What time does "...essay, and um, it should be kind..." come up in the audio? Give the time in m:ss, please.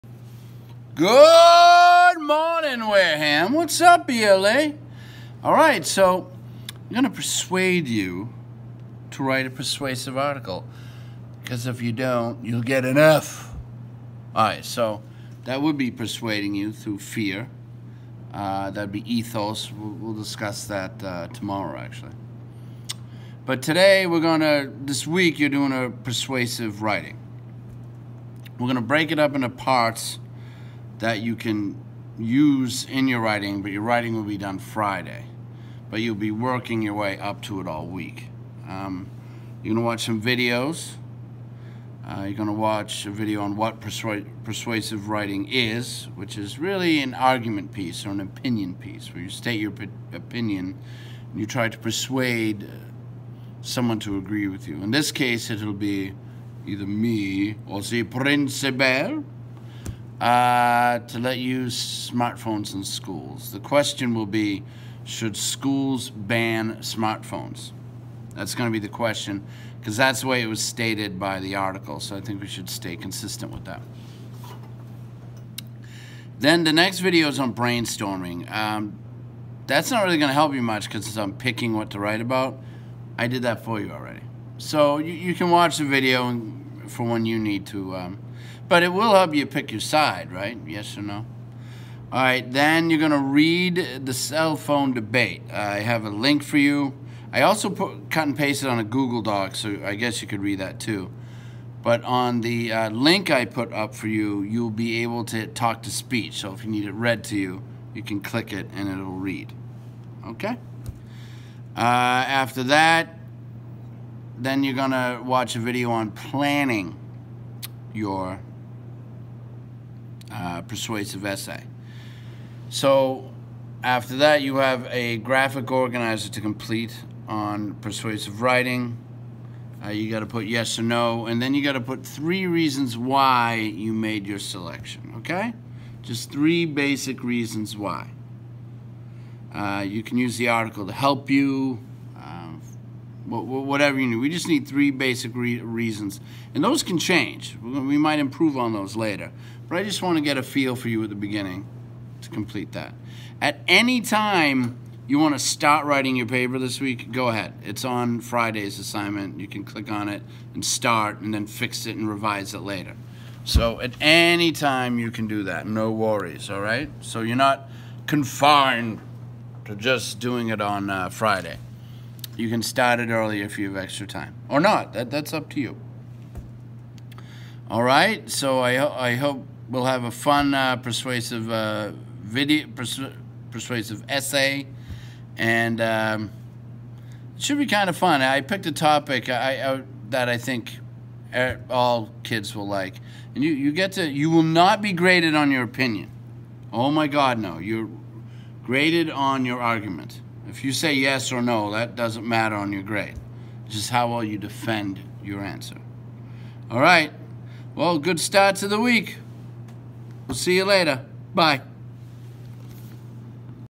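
3:04.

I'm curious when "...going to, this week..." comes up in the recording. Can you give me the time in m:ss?
0:24.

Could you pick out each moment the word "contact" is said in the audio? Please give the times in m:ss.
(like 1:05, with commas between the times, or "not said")
not said.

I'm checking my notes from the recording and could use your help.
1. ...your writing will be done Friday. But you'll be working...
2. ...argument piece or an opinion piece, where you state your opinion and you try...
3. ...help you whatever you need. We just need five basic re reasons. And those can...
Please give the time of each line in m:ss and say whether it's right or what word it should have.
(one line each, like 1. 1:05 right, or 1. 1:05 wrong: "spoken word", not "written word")
1. 0:33 right
2. 0:47 right
3. 2:20 wrong: "three", not "five".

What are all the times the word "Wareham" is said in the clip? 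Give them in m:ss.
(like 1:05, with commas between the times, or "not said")
0:02.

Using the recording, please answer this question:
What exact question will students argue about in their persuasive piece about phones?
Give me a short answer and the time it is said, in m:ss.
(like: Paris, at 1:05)
Should schools ban smartphones?, at 1:05.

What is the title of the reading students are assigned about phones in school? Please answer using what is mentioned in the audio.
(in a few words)
The cell phone debate.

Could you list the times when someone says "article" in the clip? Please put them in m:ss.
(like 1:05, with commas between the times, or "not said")
0:10, 1:11, 2:20.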